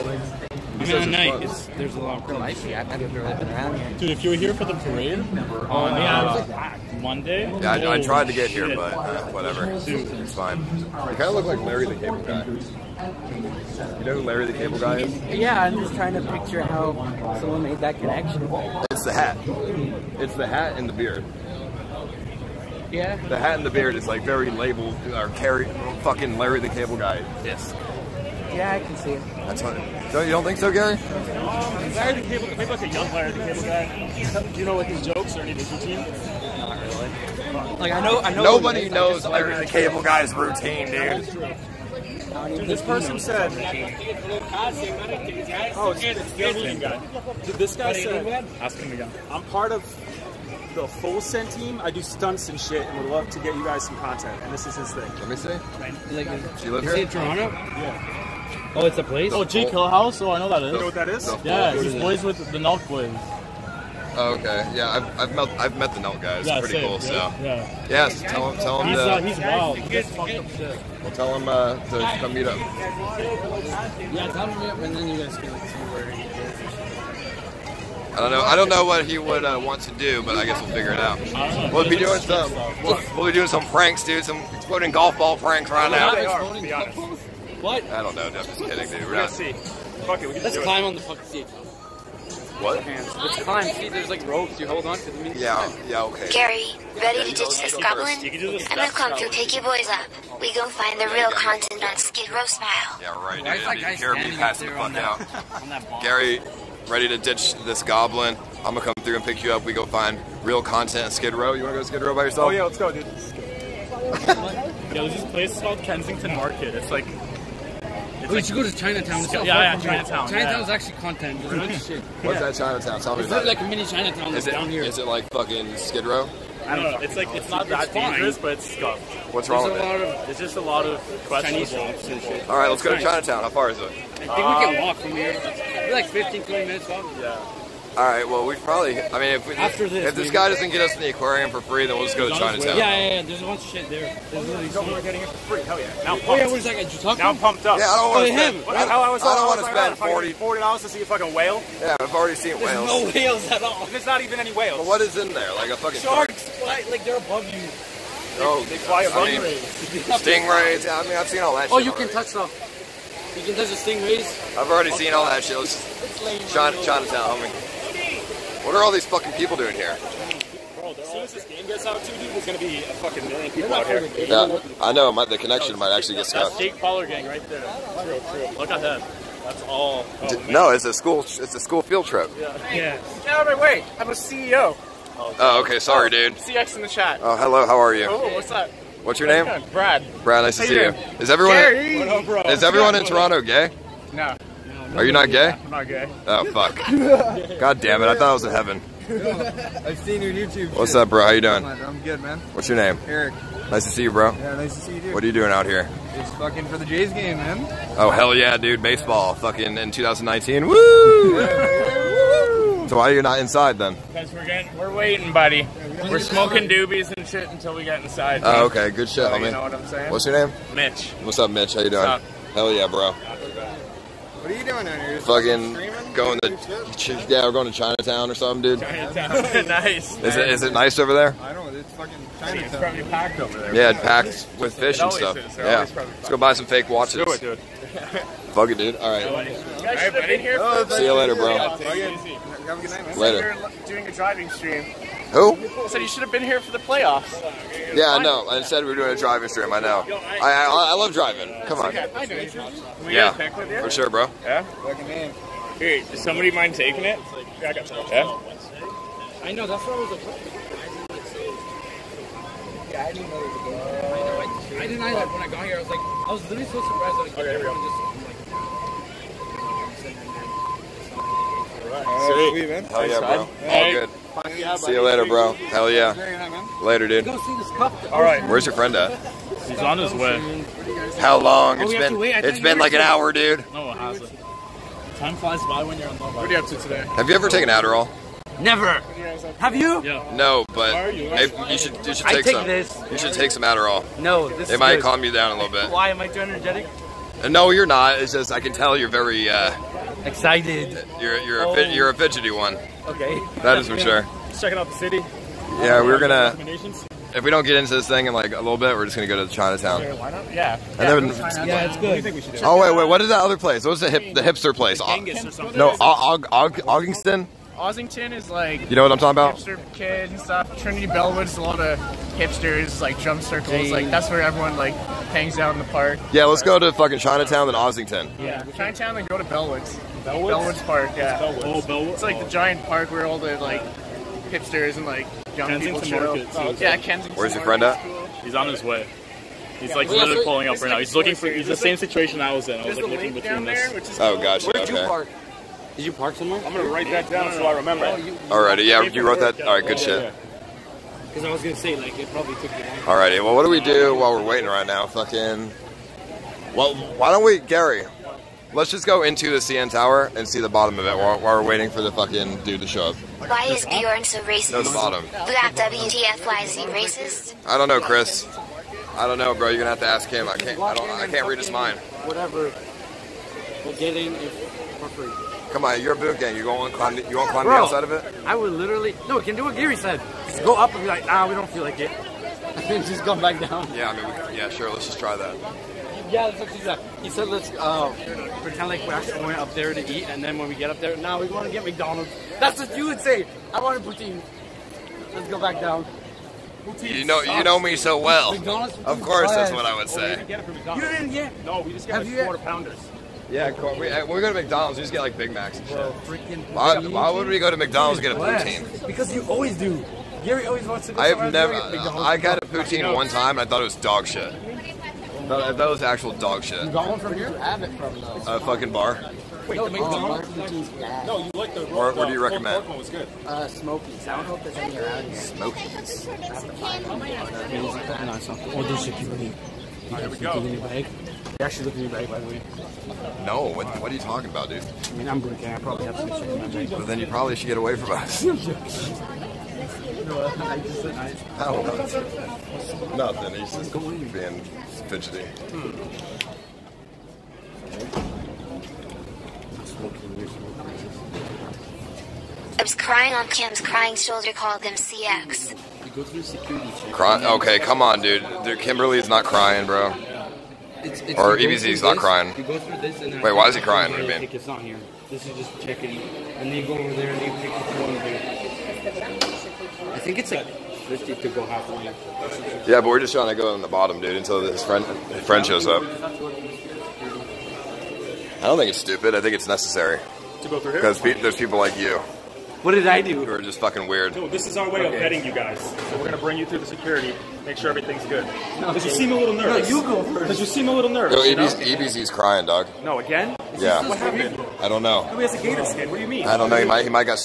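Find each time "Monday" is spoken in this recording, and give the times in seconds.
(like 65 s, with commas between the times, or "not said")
7 s.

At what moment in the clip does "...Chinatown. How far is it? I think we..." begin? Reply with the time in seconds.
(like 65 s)
133 s.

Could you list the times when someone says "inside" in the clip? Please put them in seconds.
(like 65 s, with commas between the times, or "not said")
213 s, 218 s.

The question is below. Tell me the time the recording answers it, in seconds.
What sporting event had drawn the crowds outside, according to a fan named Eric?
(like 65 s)
206 s.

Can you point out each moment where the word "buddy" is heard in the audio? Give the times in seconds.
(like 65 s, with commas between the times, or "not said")
215 s, 240 s.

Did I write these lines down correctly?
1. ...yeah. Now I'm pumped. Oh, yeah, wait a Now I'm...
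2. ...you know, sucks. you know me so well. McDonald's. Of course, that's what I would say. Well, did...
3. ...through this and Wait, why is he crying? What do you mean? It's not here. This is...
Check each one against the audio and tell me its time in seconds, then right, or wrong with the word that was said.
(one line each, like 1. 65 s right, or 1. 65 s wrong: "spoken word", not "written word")
1. 145 s right
2. 397 s right
3. 462 s right.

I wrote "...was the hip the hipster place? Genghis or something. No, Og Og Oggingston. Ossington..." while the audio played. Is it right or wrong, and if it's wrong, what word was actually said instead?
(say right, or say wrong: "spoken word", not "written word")
right.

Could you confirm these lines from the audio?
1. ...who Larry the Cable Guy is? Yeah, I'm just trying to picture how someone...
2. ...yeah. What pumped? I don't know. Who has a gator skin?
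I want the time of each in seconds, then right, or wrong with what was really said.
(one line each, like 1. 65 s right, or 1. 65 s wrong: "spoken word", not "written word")
1. 14 s right
2. 493 s wrong: "happened", not "pumped".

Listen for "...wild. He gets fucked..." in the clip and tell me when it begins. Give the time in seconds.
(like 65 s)
69 s.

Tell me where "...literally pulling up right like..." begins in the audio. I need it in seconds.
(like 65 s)
340 s.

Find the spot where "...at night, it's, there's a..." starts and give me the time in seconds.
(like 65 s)
0 s.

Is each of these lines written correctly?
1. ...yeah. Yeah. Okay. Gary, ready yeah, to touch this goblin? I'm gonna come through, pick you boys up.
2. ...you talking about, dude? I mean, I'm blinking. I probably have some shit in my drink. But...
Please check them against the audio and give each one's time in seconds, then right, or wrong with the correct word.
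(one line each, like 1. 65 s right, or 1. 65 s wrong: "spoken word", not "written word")
1. 95 s wrong: "ditch", not "touch"
2. 434 s right.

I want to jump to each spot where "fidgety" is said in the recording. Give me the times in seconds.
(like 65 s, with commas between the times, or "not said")
302 s, 445 s.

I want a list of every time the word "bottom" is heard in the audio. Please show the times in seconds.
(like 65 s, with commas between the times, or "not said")
360 s, 364 s, 473 s.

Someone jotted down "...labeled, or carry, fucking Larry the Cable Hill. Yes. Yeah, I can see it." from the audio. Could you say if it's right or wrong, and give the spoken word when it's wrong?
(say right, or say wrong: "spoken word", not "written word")
wrong: "Guy", not "Hill".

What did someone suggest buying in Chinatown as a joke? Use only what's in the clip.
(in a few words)
fake watches.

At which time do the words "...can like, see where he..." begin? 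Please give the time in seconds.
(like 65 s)
75 s.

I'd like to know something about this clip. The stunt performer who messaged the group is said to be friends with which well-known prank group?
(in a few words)
Nelk boys.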